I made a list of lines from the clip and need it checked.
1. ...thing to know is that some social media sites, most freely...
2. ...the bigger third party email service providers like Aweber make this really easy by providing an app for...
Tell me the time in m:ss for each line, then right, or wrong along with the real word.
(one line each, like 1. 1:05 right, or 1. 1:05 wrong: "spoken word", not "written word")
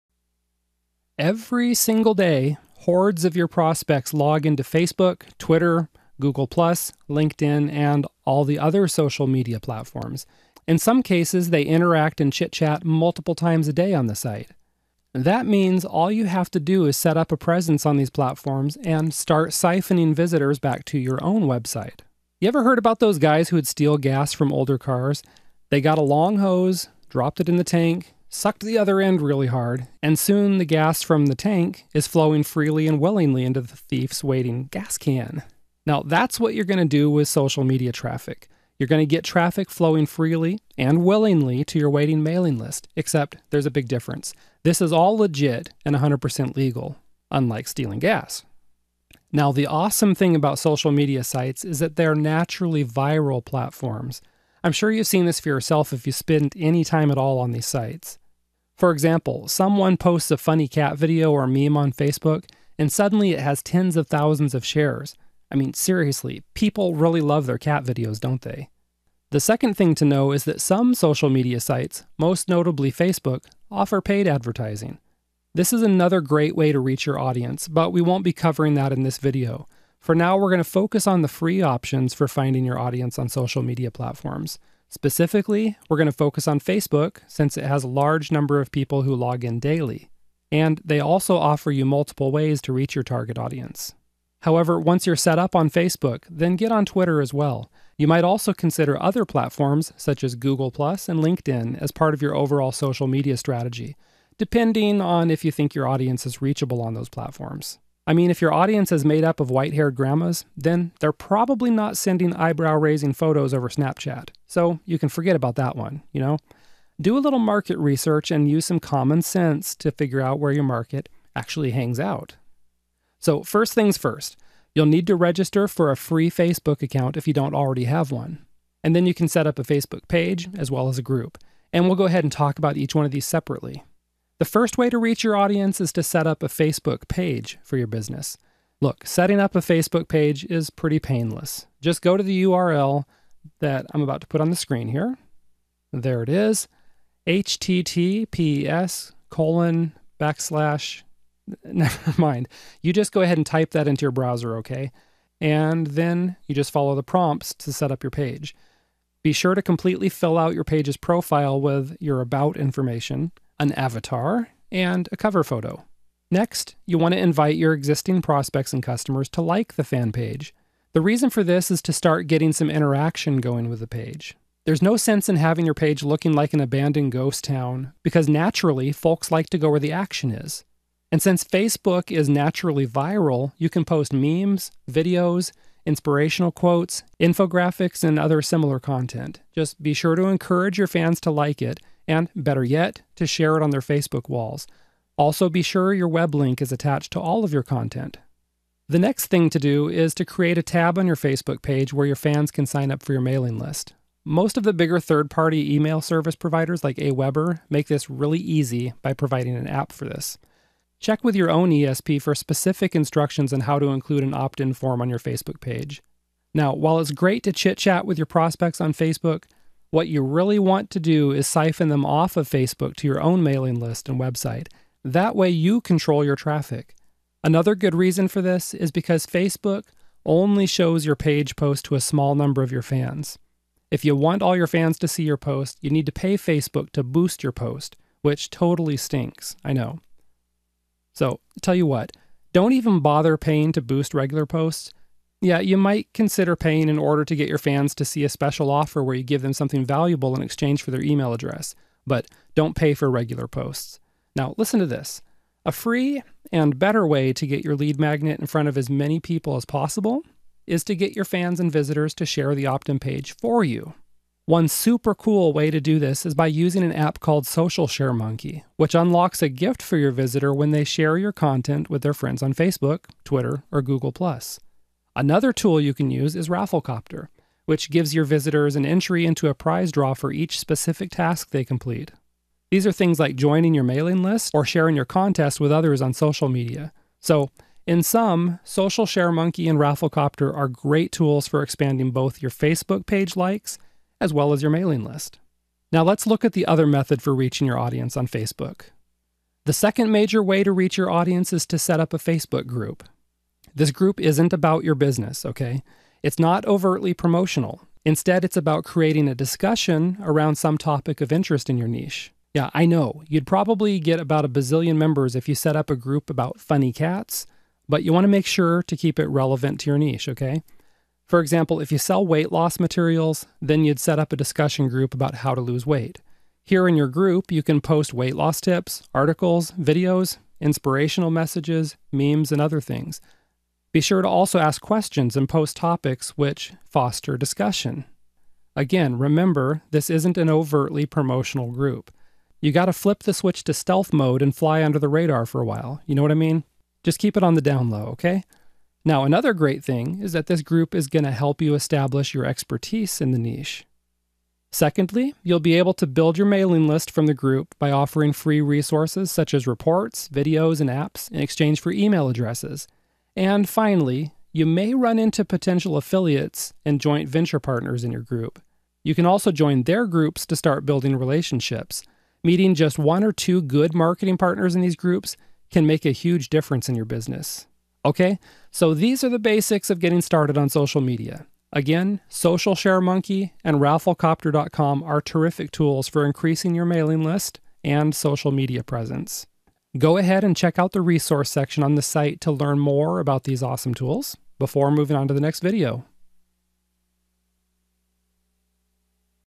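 1. 1:09 wrong: "notably", not "freely"
2. 3:24 right.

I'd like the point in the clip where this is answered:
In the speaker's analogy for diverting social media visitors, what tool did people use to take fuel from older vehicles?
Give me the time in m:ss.
0:25.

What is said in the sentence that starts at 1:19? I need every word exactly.
For now, we're going to focus on the free options for finding your audience on social media platforms.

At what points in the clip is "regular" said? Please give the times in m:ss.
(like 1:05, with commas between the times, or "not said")
4:04, 4:13.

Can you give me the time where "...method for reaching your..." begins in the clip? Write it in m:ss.
4:56.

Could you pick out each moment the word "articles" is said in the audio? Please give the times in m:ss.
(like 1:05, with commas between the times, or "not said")
5:29.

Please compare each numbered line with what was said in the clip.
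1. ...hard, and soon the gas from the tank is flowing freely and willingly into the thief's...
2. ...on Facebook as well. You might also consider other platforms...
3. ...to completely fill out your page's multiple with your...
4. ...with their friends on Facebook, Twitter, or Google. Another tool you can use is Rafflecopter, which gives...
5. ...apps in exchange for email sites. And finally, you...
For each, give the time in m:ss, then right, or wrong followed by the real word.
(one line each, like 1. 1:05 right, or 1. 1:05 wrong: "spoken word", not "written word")
1. 0:29 right
2. 1:36 wrong: "Twitter", not "Facebook"
3. 2:39 wrong: "profile", not "multiple"
4. 4:31 right
5. 6:00 wrong: "addresses", not "sites".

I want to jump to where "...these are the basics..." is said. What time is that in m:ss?
6:18.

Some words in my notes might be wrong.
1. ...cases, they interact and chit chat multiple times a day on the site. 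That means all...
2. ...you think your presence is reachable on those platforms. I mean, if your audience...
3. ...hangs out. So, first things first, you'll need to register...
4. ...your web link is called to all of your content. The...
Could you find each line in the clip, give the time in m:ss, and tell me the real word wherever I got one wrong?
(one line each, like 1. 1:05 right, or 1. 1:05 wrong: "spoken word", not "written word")
1. 0:11 right
2. 1:45 wrong: "audience", not "presence"
3. 2:01 right
4. 3:15 wrong: "attached", not "called".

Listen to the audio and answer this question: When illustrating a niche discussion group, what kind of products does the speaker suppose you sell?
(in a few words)
weight loss materials.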